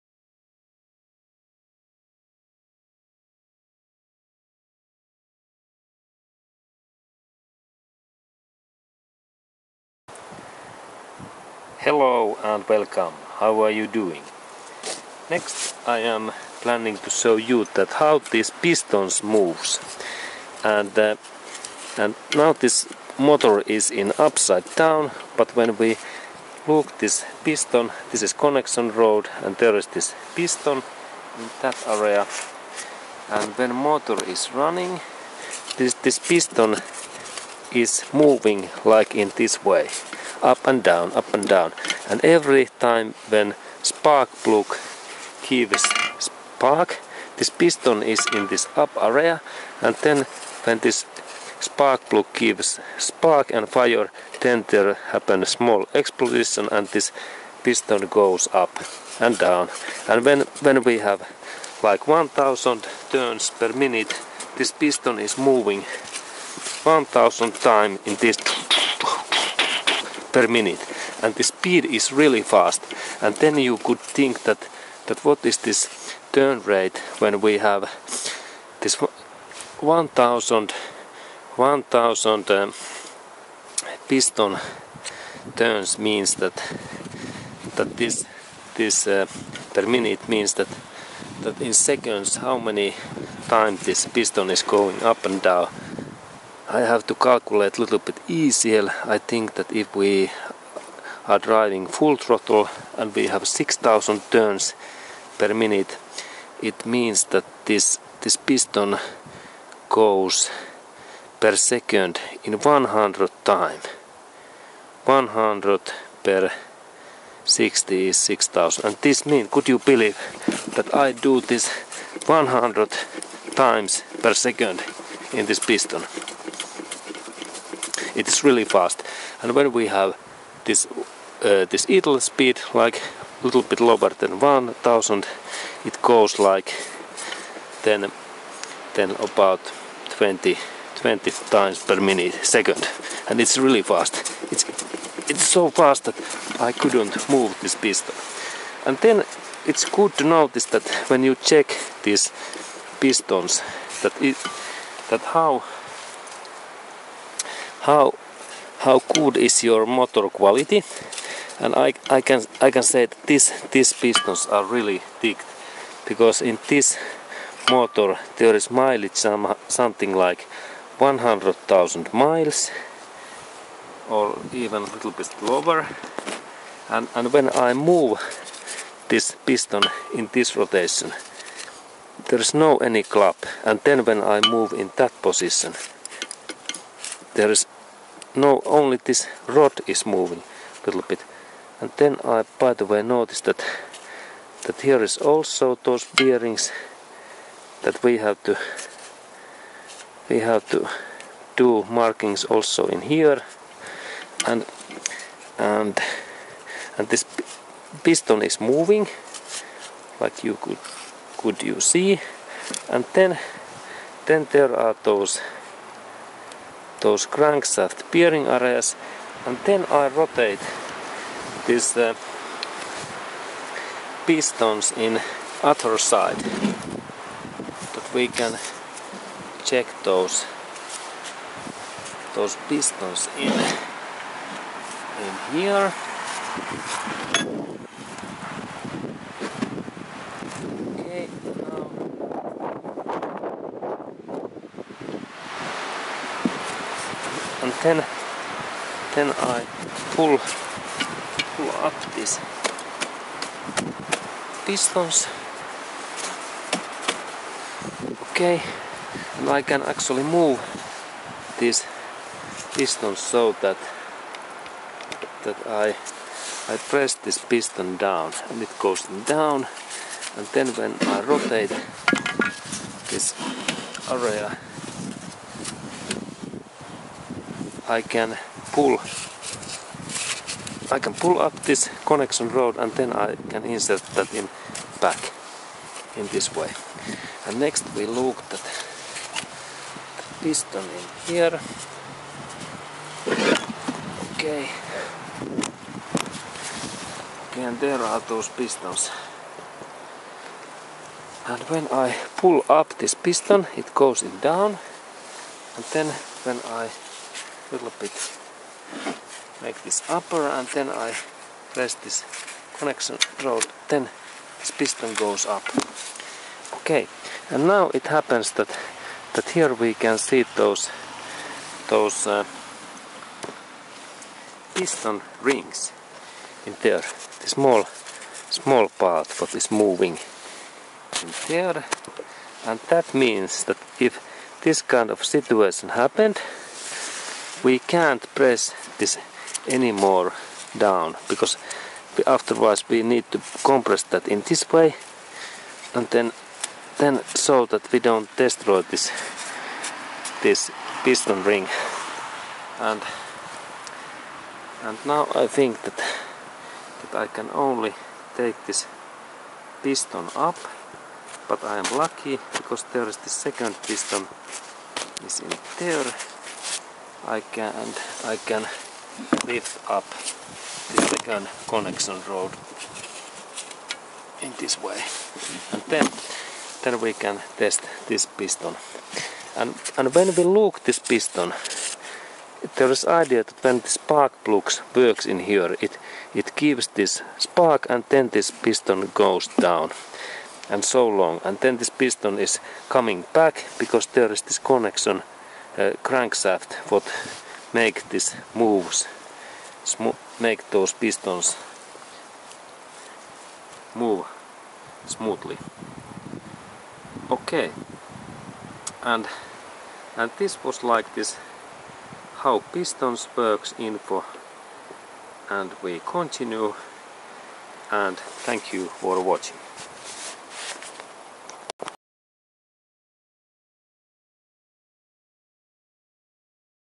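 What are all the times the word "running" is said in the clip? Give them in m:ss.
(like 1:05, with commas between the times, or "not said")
0:34.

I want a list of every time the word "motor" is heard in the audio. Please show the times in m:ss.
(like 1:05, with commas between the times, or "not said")
0:23, 0:33, 2:39, 2:47.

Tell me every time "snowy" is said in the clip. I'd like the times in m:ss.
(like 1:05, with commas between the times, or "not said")
not said.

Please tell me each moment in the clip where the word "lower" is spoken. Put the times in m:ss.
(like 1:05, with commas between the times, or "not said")
2:13, 2:55.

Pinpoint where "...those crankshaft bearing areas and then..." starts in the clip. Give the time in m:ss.
3:37.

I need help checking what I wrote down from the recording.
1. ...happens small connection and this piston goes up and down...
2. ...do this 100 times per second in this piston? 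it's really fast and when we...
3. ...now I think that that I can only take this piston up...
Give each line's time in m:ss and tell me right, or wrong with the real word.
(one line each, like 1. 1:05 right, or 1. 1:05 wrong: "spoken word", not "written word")
1. 0:55 wrong: "explosion", not "connection"
2. 2:01 right
3. 5:55 right.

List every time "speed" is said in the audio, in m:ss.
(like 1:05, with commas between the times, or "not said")
1:11, 2:12.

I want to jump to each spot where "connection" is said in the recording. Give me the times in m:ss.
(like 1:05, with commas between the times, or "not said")
0:28, 4:42, 5:12, 6:11, 6:34.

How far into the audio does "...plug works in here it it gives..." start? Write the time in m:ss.
6:24.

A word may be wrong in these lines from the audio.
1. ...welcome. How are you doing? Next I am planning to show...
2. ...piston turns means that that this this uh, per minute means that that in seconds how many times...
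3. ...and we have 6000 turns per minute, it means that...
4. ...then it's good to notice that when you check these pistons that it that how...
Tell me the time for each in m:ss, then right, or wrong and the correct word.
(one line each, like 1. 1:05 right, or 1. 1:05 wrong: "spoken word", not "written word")
1. 0:12 right
2. 1:24 right
3. 1:42 right
4. 2:28 right.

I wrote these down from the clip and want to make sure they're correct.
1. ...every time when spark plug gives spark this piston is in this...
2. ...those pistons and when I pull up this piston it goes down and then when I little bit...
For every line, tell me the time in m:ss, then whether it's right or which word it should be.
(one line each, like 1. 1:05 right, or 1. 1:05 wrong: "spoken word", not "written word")
1. 0:42 right
2. 4:58 right.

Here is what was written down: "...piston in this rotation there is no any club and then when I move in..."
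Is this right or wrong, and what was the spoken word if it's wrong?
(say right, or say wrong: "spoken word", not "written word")
right.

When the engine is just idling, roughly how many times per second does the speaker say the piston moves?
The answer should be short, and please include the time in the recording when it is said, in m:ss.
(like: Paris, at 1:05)
20, at 2:20.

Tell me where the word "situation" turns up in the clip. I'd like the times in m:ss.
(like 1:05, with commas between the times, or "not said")
5:35.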